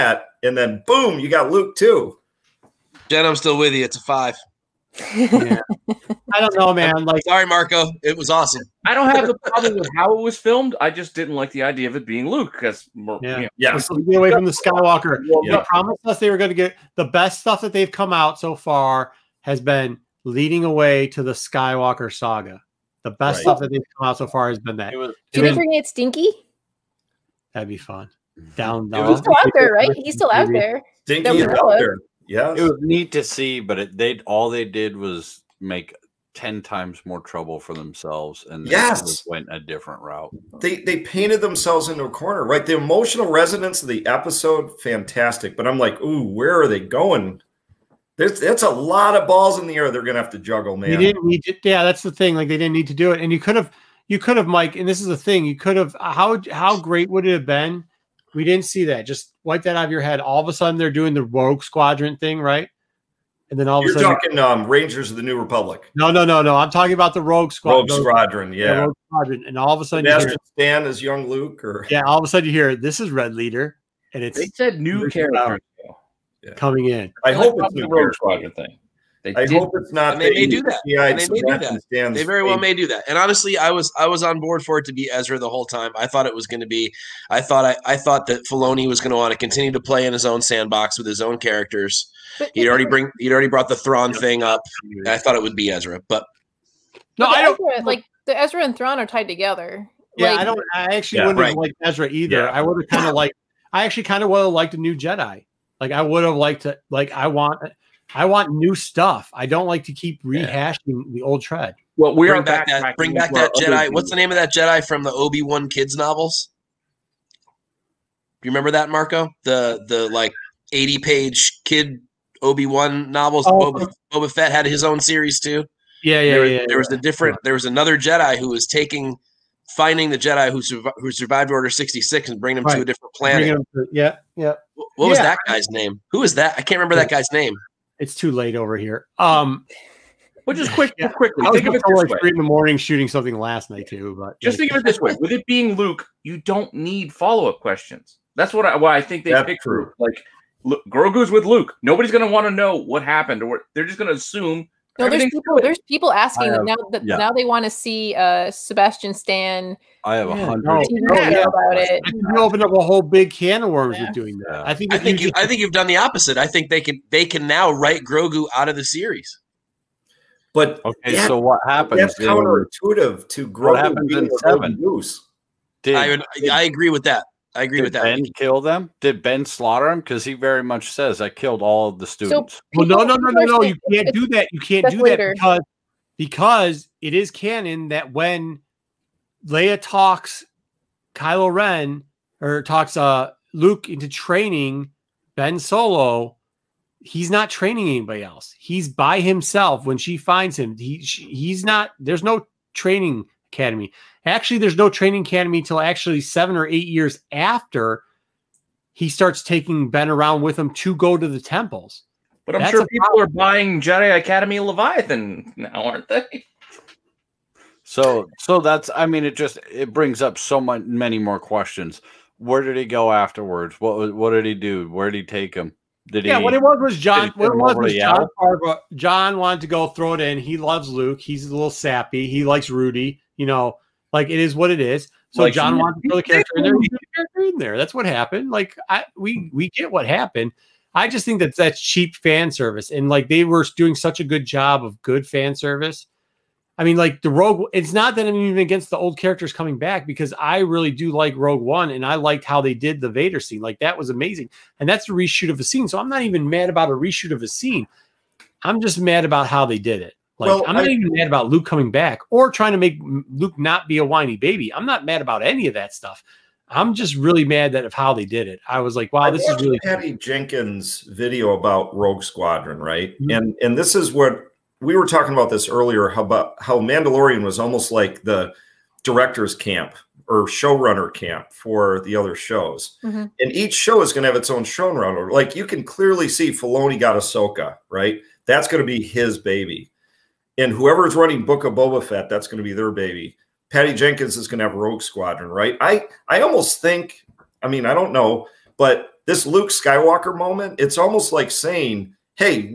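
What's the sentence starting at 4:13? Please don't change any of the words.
Like that was amazing, and that's a reshoot of a scene.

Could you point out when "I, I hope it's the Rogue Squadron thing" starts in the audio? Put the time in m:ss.
1:17.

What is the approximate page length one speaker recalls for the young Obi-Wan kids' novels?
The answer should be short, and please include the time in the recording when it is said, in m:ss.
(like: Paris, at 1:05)
80, at 2:00.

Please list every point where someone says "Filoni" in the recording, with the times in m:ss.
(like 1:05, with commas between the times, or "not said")
1:28, 4:46.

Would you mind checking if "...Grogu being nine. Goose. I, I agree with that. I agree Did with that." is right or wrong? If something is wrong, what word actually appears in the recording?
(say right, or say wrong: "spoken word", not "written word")
wrong: "seven", not "nine".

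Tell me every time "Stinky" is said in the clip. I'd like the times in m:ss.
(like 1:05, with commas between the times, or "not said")
0:25, 0:31.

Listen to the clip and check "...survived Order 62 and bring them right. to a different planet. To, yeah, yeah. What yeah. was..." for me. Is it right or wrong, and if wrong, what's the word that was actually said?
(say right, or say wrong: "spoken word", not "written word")
wrong: "66", not "62".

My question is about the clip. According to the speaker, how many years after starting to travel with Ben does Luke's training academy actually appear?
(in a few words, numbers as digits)
7 or 8.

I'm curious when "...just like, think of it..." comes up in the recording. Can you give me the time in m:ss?
2:24.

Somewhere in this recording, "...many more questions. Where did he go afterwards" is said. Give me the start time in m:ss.
3:40.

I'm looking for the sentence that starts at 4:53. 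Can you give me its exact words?
Patty Jenkins is going to have Rogue Squadron, right?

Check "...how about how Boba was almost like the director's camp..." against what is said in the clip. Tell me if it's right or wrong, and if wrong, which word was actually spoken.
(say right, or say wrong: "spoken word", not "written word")
wrong: "Mandalorian", not "Boba".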